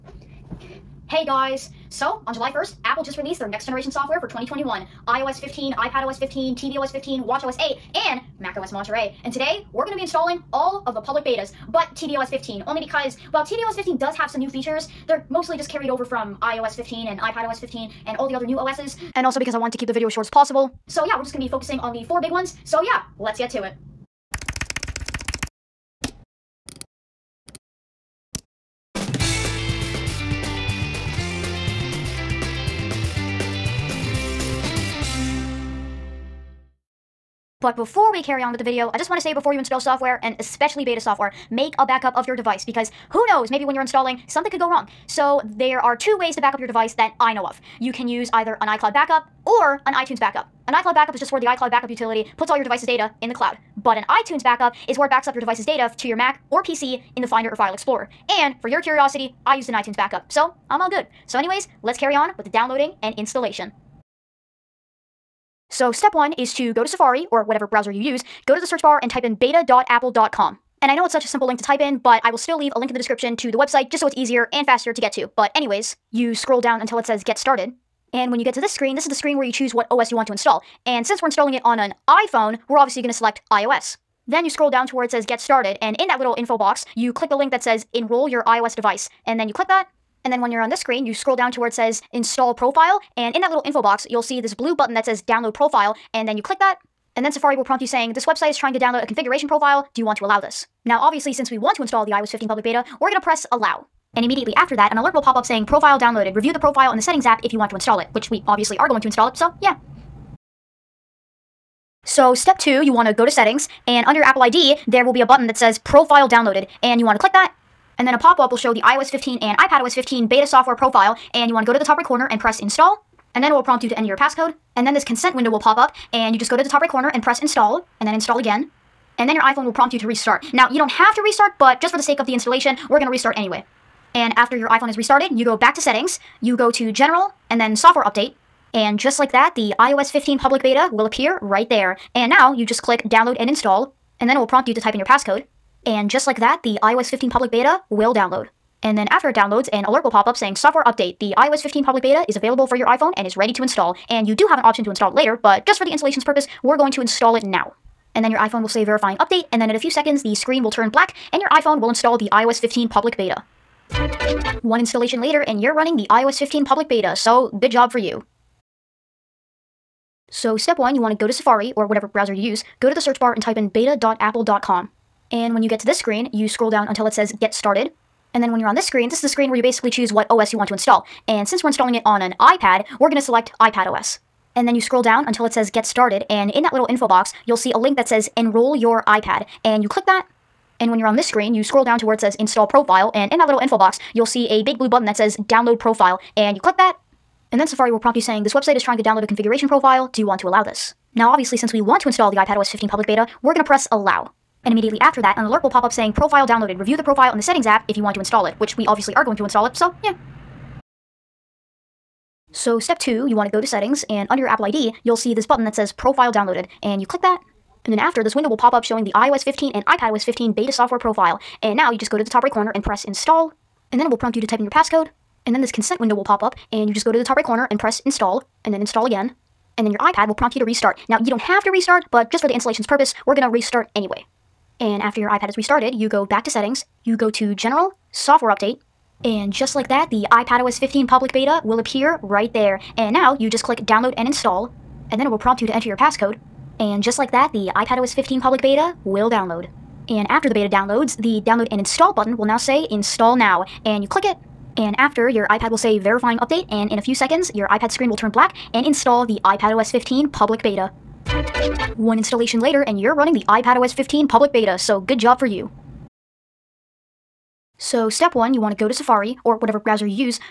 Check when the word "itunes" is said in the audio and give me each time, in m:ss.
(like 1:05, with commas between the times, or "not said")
0:49, 0:54, 0:59.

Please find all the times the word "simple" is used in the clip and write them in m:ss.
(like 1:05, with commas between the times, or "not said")
1:11.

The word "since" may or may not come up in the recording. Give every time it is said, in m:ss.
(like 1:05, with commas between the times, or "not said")
1:21, 1:41, 3:01, 3:21.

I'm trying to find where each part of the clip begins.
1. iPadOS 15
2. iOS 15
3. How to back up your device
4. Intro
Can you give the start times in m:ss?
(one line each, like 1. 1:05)
1. 2:48
2. 1:04
3. 0:37
4. 0:23.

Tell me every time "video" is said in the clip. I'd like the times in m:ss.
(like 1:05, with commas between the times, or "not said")
0:19, 0:38.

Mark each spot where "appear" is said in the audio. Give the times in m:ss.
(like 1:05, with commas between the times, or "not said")
2:21, 4:01.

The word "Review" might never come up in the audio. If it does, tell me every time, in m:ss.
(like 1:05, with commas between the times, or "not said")
1:46, 3:26.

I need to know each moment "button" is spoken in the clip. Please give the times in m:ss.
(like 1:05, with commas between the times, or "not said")
1:34, 1:55, 3:14, 3:35, 4:12.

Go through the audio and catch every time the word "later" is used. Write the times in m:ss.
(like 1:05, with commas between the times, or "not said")
2:35, 2:45, 4:22.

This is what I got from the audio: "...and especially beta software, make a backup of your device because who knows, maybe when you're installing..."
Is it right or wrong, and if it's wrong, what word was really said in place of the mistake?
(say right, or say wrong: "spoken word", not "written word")
right.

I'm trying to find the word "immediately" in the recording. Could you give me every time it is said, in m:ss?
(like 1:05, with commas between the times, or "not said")
1:44, 3:24.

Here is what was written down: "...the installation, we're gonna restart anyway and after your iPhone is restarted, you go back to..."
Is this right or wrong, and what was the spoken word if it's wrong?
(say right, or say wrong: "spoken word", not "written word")
right.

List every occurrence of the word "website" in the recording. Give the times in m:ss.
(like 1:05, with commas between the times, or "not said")
1:13, 1:38, 3:18.